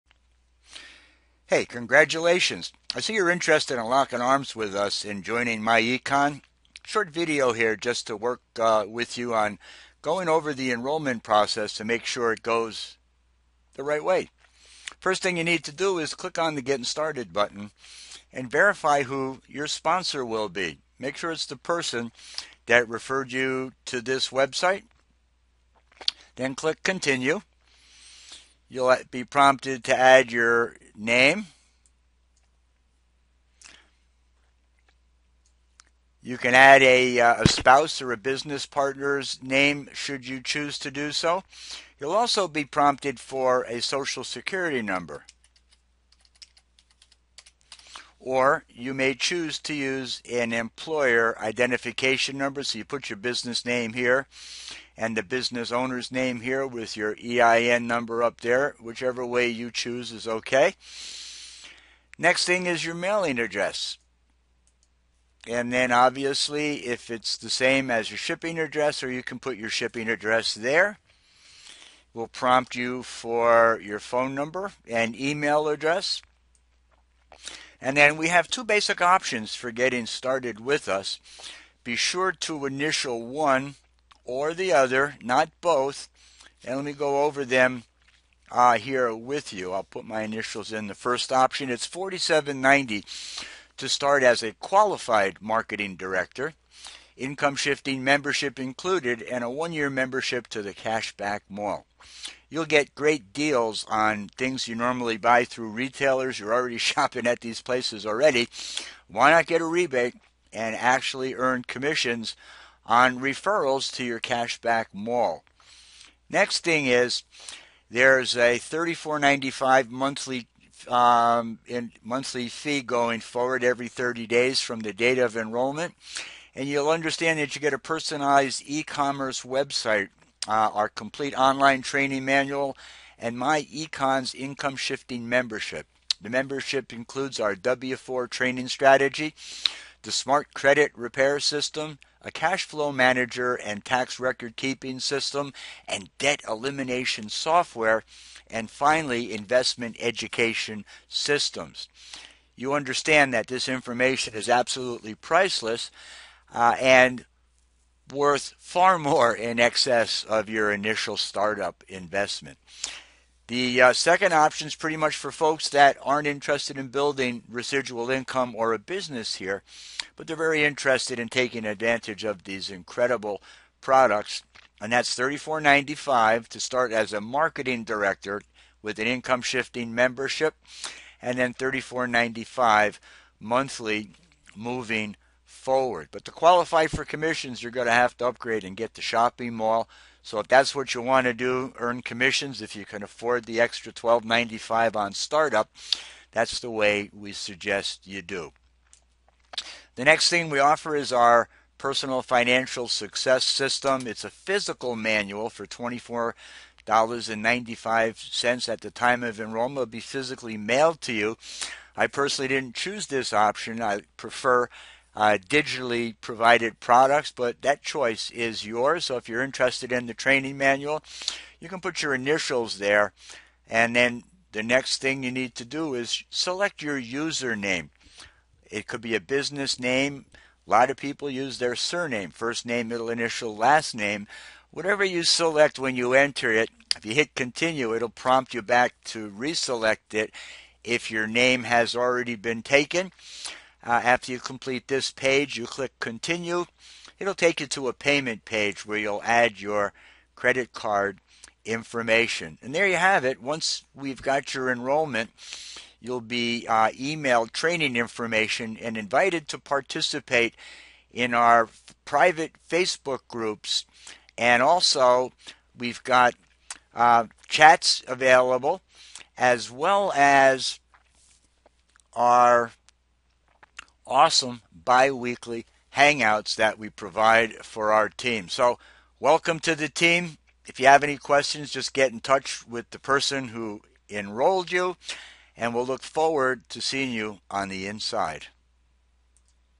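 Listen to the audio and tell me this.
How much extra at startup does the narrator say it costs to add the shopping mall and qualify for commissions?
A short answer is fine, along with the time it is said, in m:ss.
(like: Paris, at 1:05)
$12.95, at 3:13.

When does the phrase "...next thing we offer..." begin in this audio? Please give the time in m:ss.
3:20.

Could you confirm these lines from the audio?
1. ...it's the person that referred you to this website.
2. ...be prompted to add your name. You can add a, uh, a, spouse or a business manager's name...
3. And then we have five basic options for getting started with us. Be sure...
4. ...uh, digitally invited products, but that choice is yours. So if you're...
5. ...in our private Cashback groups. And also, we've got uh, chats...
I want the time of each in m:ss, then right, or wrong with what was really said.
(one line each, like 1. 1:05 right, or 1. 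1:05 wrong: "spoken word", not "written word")
1. 0:21 right
2. 0:29 wrong: "partner", not "manager"
3. 1:17 wrong: "two", not "five"
4. 3:35 wrong: "provided", not "invited"
5. 4:21 wrong: "Facebook", not "Cashback".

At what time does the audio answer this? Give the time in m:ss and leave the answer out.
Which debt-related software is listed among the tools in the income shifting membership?
2:26.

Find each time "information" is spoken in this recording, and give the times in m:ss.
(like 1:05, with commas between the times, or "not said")
2:33, 4:11, 4:17.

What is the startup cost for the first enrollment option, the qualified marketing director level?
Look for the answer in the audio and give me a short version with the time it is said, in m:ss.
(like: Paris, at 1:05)
4790, at 1:31.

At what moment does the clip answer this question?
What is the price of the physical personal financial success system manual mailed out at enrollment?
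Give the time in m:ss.
3:25.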